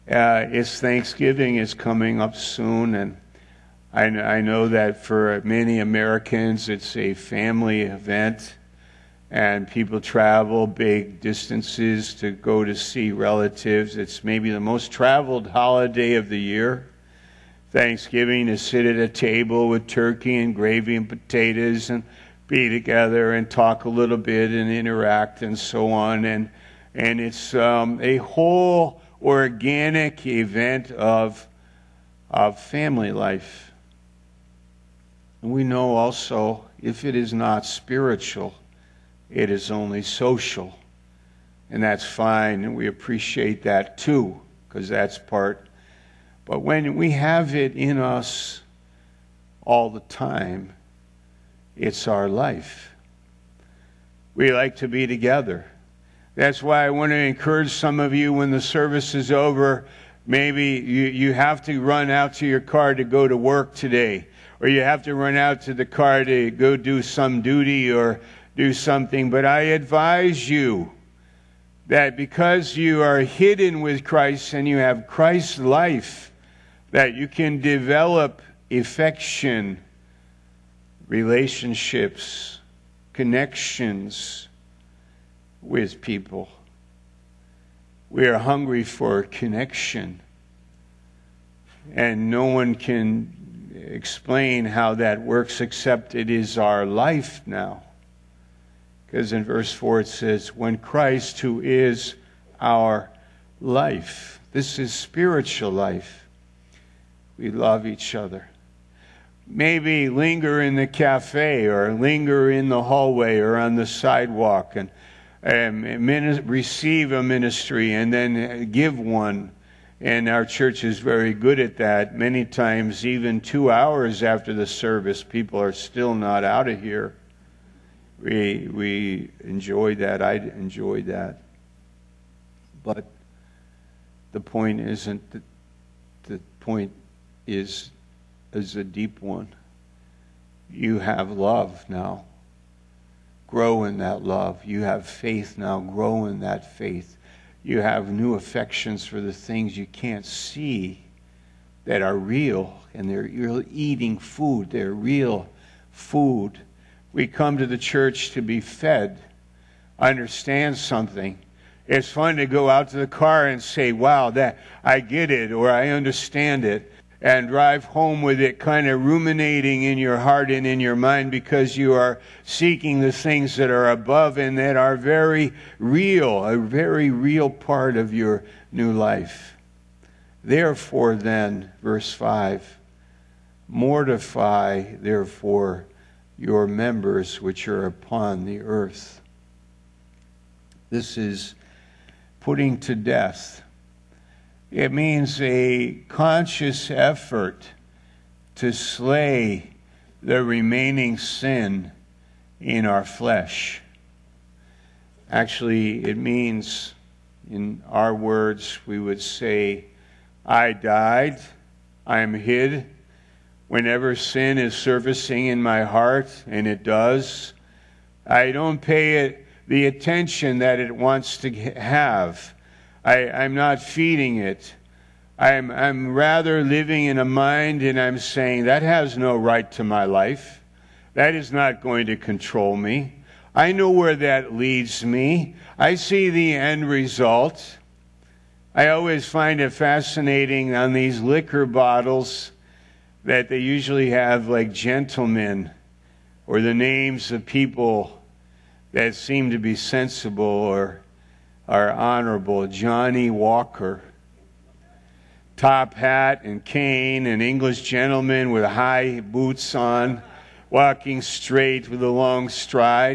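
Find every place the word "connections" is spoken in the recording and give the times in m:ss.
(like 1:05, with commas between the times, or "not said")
1:23, 1:29.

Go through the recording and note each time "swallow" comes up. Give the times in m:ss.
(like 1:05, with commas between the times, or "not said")
not said.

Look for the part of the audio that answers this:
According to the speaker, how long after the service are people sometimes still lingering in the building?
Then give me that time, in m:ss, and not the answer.
2:03.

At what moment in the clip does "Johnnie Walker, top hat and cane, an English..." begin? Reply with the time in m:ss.
4:12.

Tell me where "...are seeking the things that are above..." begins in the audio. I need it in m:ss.
2:51.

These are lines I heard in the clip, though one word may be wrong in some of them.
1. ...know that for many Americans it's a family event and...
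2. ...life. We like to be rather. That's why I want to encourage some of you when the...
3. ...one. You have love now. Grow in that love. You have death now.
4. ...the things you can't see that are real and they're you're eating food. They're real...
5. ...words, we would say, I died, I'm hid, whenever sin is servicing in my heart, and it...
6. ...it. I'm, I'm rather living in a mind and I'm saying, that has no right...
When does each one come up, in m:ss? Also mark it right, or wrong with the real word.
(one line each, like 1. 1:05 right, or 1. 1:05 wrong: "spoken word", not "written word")
1. 0:04 right
2. 0:52 wrong: "together", not "rather"
3. 2:19 wrong: "faith", not "death"
4. 2:29 right
5. 3:28 right
6. 3:44 right.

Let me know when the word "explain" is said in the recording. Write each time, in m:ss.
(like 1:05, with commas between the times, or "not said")
1:33.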